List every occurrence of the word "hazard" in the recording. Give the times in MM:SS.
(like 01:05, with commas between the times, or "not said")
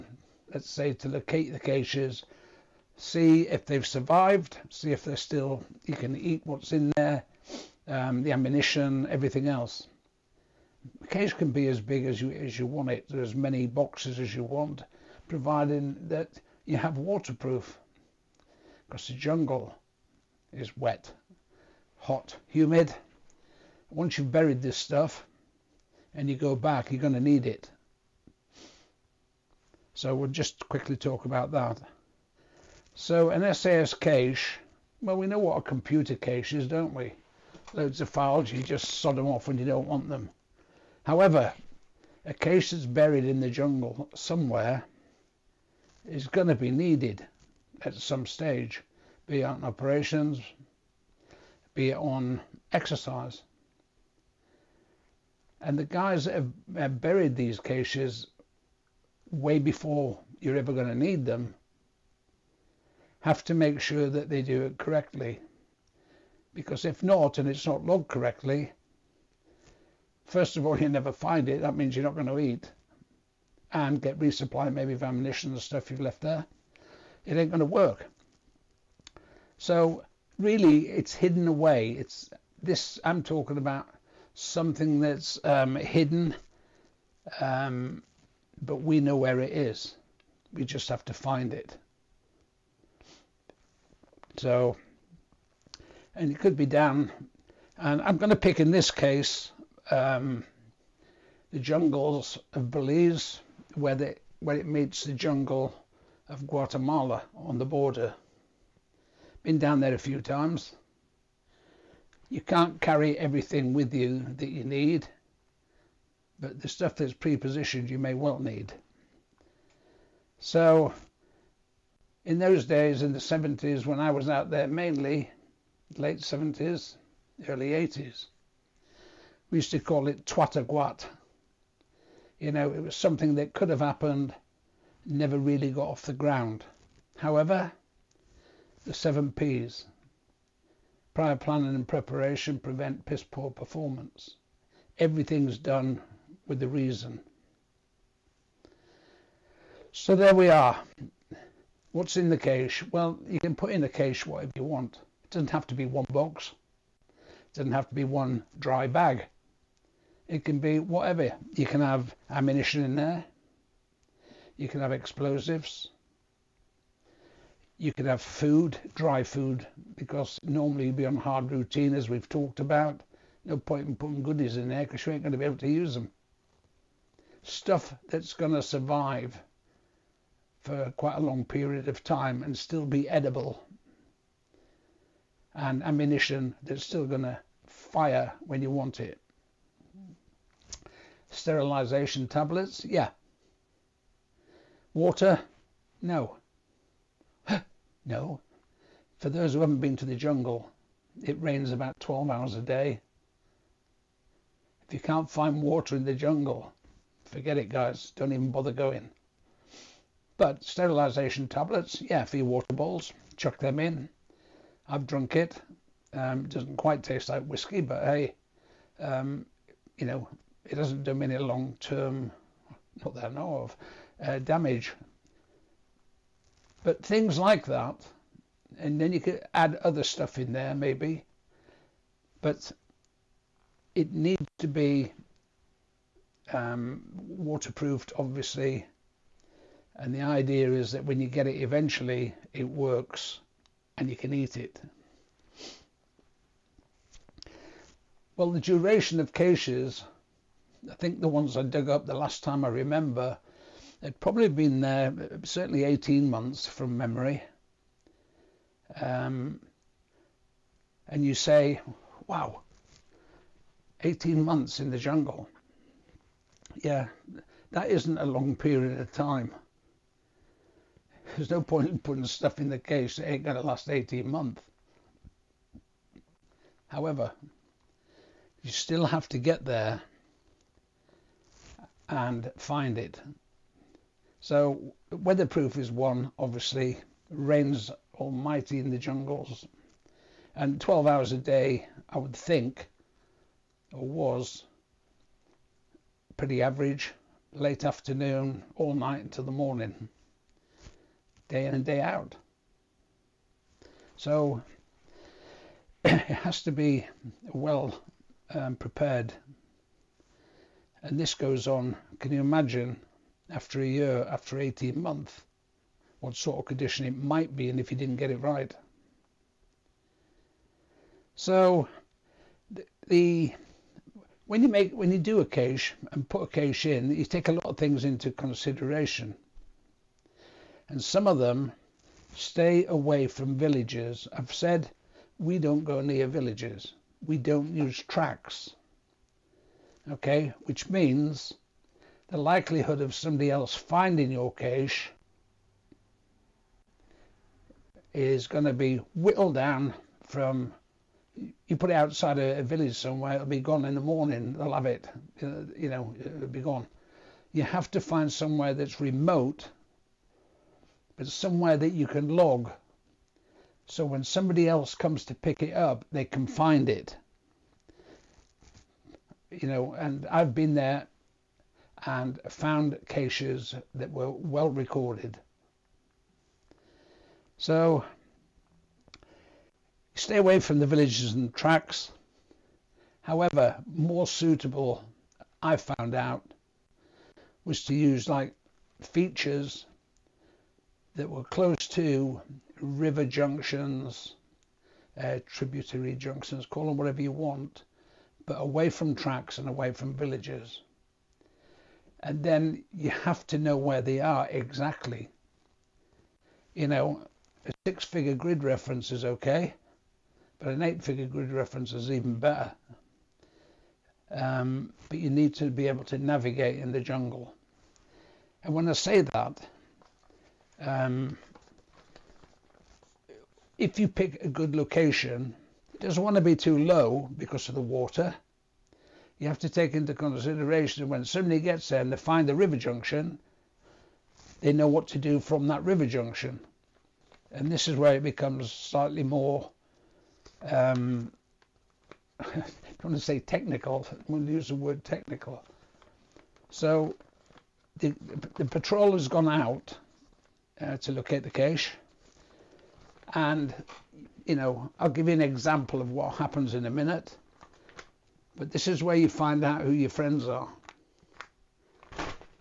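not said.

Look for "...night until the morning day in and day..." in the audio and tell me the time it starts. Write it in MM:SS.
04:58.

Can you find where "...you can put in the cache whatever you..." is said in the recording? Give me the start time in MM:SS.
02:33.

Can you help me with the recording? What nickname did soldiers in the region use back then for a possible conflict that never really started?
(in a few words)
twataguat.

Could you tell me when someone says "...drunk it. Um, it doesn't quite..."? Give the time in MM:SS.
03:35.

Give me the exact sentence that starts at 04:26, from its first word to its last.
Yeah, that isn't a long period of time.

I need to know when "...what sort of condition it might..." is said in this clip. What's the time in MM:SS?
05:16.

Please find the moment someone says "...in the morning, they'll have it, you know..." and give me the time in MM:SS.
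05:53.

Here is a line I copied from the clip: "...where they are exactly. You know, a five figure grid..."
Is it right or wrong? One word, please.
wrong.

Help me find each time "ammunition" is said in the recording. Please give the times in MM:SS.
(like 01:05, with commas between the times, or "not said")
00:08, 01:15, 02:42, 03:05.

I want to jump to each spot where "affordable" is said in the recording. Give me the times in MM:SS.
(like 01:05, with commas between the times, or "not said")
not said.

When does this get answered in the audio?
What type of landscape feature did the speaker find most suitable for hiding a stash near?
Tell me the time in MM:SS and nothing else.
06:32.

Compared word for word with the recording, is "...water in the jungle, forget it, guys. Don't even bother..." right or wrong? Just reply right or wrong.
right.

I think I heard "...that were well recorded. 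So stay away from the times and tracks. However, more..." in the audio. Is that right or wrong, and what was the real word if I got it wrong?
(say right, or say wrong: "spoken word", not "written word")
wrong: "villages", not "times".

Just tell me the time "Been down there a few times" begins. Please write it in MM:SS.
01:49.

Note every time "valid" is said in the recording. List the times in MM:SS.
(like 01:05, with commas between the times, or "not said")
not said.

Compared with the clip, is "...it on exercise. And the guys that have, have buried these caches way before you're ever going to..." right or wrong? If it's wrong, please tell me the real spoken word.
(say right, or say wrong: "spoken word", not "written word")
right.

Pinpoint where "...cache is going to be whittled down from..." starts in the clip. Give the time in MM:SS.
05:44.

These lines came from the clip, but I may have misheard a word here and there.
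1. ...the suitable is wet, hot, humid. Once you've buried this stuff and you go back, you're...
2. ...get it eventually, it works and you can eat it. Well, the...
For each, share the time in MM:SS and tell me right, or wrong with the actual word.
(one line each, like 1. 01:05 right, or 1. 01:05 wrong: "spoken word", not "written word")
1. 00:19 wrong: "jungle", not "suitable"
2. 04:01 right.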